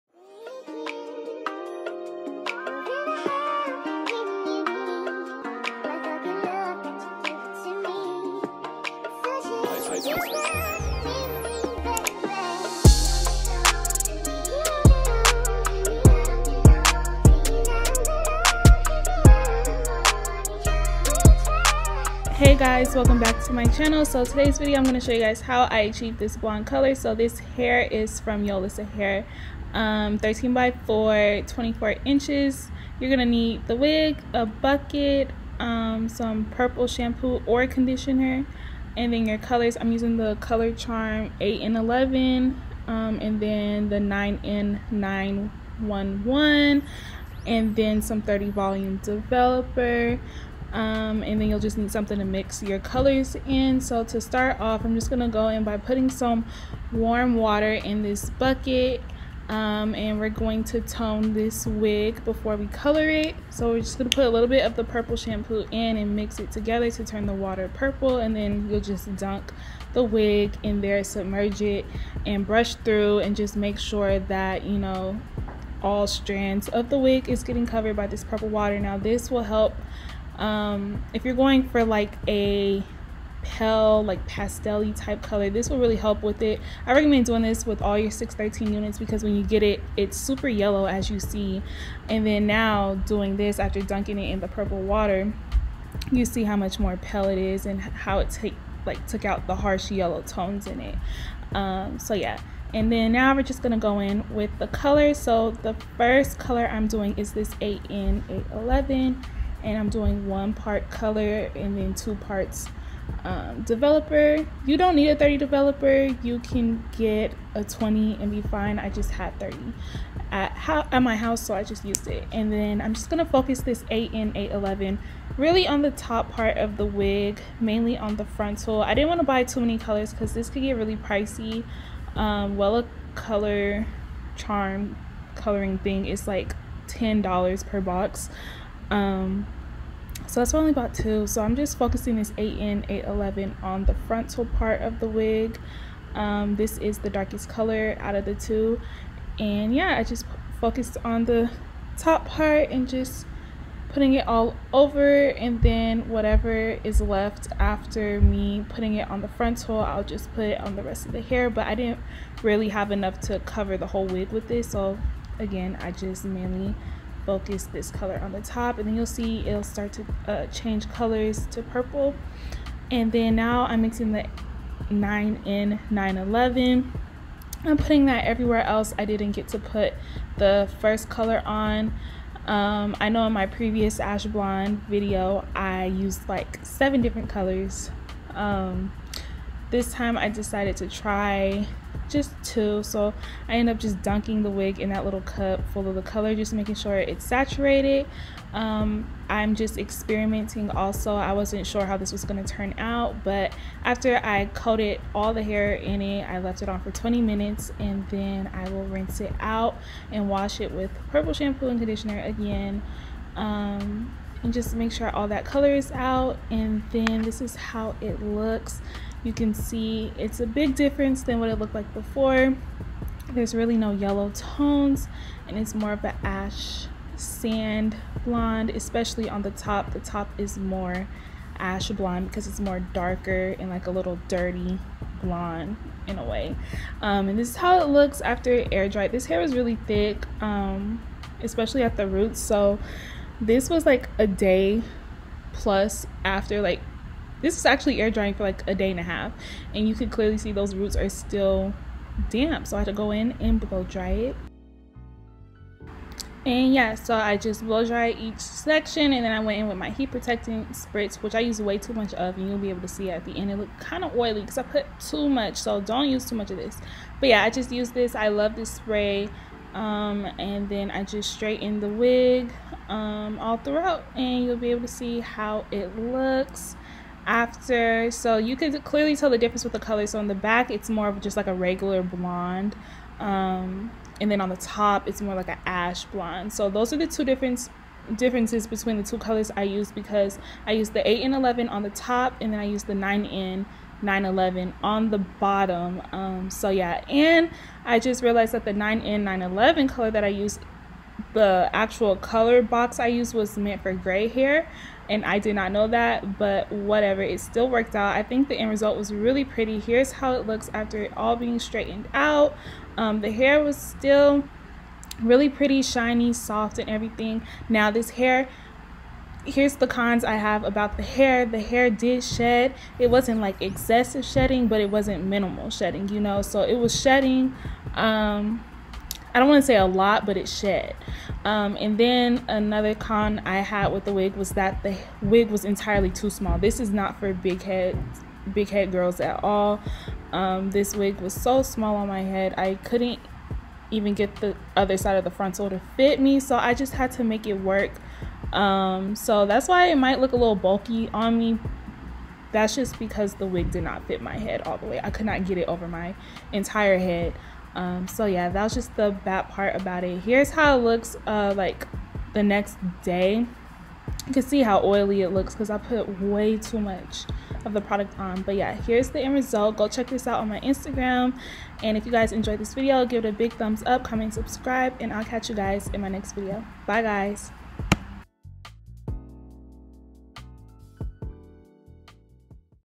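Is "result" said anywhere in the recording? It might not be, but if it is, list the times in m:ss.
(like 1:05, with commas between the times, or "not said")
5:08, 6:09.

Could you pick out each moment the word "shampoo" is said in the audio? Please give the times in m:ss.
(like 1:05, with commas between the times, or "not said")
0:36, 1:05, 3:31.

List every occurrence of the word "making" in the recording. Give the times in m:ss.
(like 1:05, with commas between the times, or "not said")
3:16.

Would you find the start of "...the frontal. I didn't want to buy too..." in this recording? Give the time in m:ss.
2:08.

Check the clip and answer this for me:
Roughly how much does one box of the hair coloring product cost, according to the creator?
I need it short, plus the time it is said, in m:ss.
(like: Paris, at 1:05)
$10, at 2:16.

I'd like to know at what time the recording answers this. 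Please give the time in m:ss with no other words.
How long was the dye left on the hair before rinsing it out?
3:26.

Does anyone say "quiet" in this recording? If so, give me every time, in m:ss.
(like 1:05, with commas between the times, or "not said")
not said.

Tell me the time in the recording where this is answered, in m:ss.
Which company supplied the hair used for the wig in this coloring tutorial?
0:28.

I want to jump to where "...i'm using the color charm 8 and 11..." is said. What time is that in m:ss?
0:39.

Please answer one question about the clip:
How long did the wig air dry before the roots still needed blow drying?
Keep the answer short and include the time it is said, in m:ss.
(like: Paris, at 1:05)
a day and a half, at 4:08.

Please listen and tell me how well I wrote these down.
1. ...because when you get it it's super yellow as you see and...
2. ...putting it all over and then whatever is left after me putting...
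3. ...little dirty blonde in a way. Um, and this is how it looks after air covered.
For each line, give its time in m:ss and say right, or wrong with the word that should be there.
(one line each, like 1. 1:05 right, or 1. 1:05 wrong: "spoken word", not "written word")
1. 1:28 right
2. 2:33 right
3. 3:53 wrong: "dried", not "covered".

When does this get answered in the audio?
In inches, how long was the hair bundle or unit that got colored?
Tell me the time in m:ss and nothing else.
0:31.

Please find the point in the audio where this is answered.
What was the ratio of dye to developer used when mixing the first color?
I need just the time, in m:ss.
1:50.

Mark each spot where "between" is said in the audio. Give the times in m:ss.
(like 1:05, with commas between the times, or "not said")
4:48.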